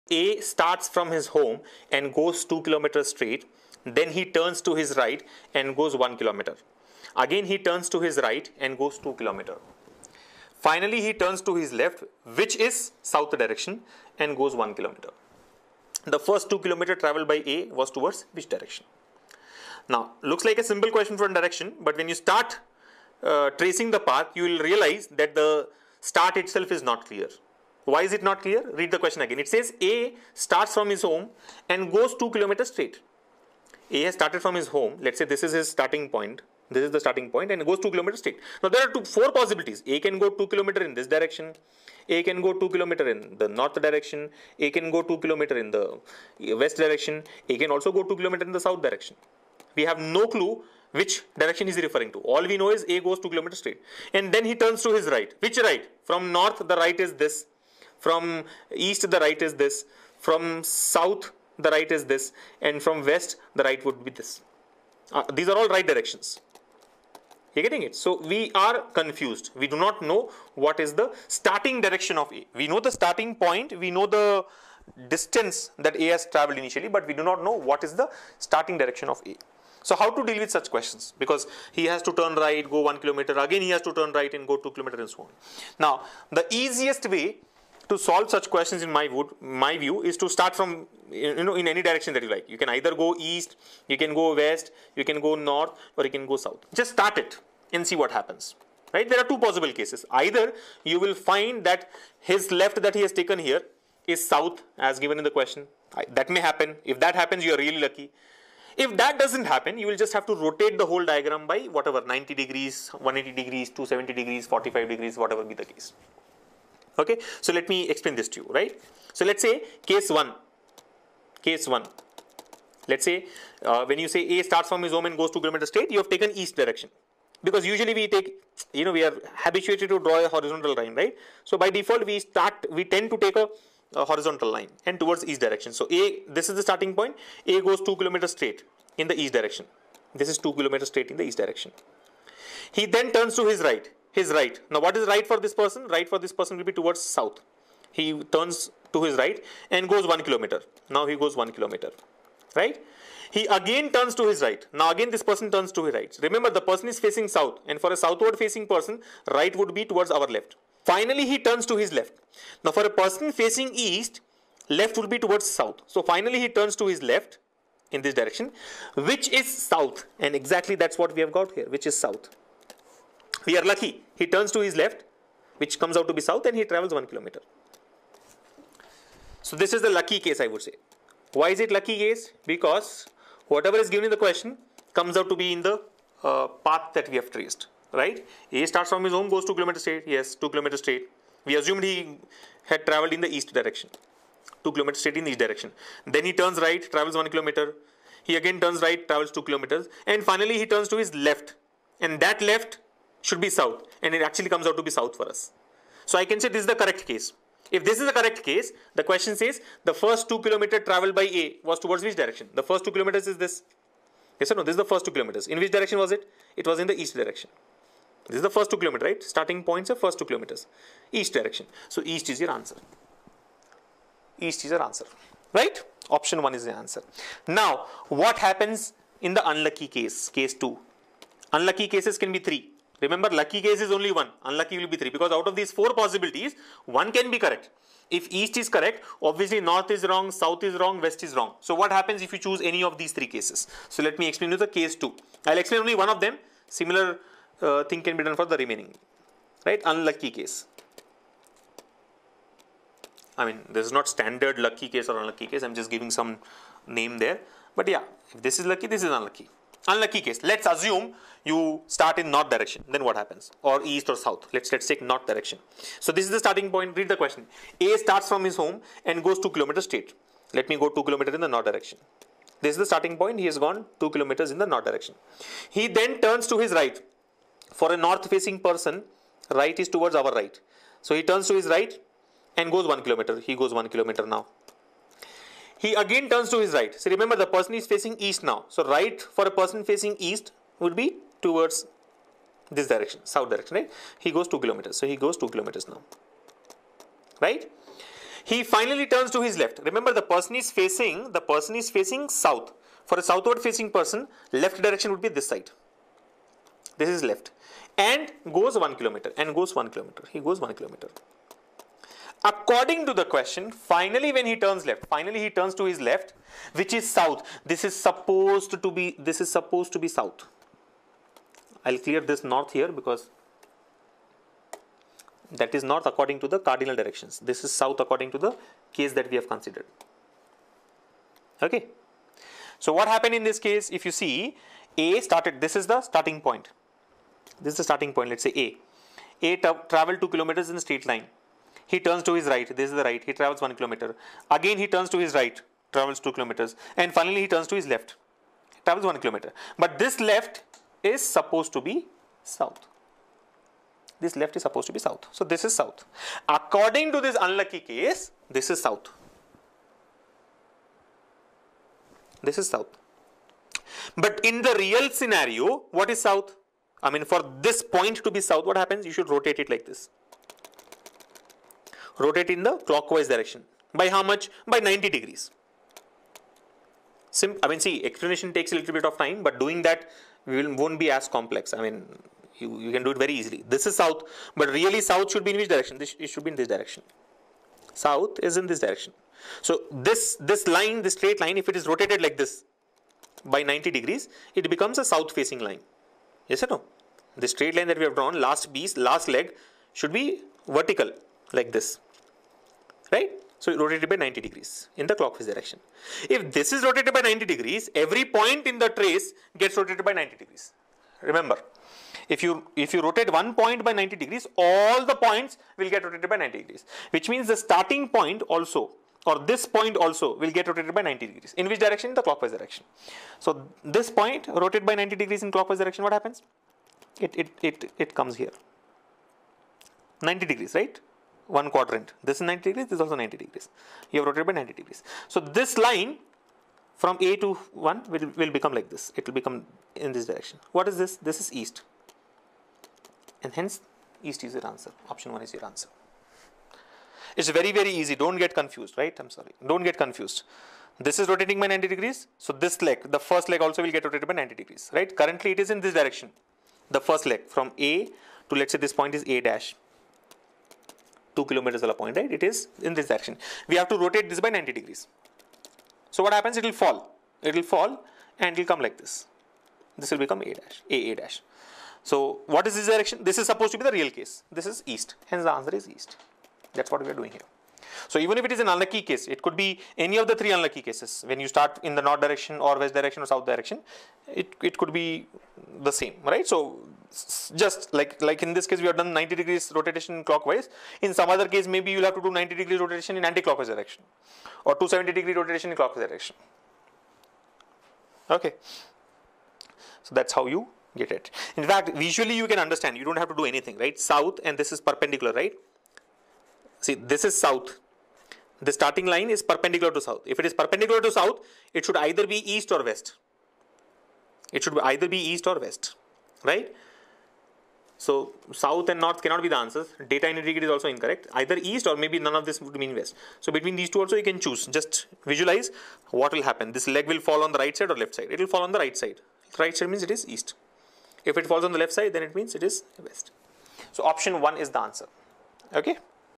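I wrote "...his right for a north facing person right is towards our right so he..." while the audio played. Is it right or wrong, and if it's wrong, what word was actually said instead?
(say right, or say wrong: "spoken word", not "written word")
right.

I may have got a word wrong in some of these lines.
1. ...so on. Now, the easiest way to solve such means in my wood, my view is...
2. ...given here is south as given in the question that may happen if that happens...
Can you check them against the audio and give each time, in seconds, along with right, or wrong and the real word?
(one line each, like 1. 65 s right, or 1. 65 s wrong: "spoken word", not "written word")
1. 85 s wrong: "questions", not "means"
2. 103 s wrong: "taken", not "given".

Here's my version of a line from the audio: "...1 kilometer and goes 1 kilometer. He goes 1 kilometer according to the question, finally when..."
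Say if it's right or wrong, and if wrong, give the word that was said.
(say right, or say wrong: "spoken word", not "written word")
right.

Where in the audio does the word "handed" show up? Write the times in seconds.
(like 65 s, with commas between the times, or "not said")
not said.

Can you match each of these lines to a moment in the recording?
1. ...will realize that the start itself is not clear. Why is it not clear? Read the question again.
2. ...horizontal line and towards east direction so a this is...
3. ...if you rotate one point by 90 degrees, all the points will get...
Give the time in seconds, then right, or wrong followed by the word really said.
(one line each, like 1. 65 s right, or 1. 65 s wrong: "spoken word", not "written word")
1. 24 s right
2. 134 s right
3. 412 s right.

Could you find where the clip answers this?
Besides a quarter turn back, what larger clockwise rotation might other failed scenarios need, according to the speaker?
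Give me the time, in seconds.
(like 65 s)
494 s.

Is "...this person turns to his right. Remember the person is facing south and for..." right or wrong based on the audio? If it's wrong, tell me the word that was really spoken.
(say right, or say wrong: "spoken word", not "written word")
right.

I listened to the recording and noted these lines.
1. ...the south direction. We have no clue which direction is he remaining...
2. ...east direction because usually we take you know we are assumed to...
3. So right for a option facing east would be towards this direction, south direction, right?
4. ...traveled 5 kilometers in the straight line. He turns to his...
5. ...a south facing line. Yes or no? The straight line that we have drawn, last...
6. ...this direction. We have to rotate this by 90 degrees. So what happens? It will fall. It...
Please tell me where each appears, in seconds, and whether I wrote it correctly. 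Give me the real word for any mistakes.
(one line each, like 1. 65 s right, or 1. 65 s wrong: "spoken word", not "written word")
1. 48 s wrong: "referring", not "remaining"
2. 126 s wrong: "habituated", not "assumed"
3. 288 s wrong: "person", not "option"
4. 339 s wrong: "2", not "5"
5. 394 s right
6. 462 s right.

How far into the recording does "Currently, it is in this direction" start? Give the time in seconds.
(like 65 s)
455 s.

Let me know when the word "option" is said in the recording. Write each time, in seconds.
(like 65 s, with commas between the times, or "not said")
226 s, 445 s, 534 s.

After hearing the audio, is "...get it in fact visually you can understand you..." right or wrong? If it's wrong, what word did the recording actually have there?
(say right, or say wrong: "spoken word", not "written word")
right.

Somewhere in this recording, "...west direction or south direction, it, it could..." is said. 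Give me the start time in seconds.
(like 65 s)
482 s.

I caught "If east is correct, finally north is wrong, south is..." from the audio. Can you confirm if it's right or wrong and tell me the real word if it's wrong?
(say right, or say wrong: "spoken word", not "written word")
wrong: "obviously", not "finally".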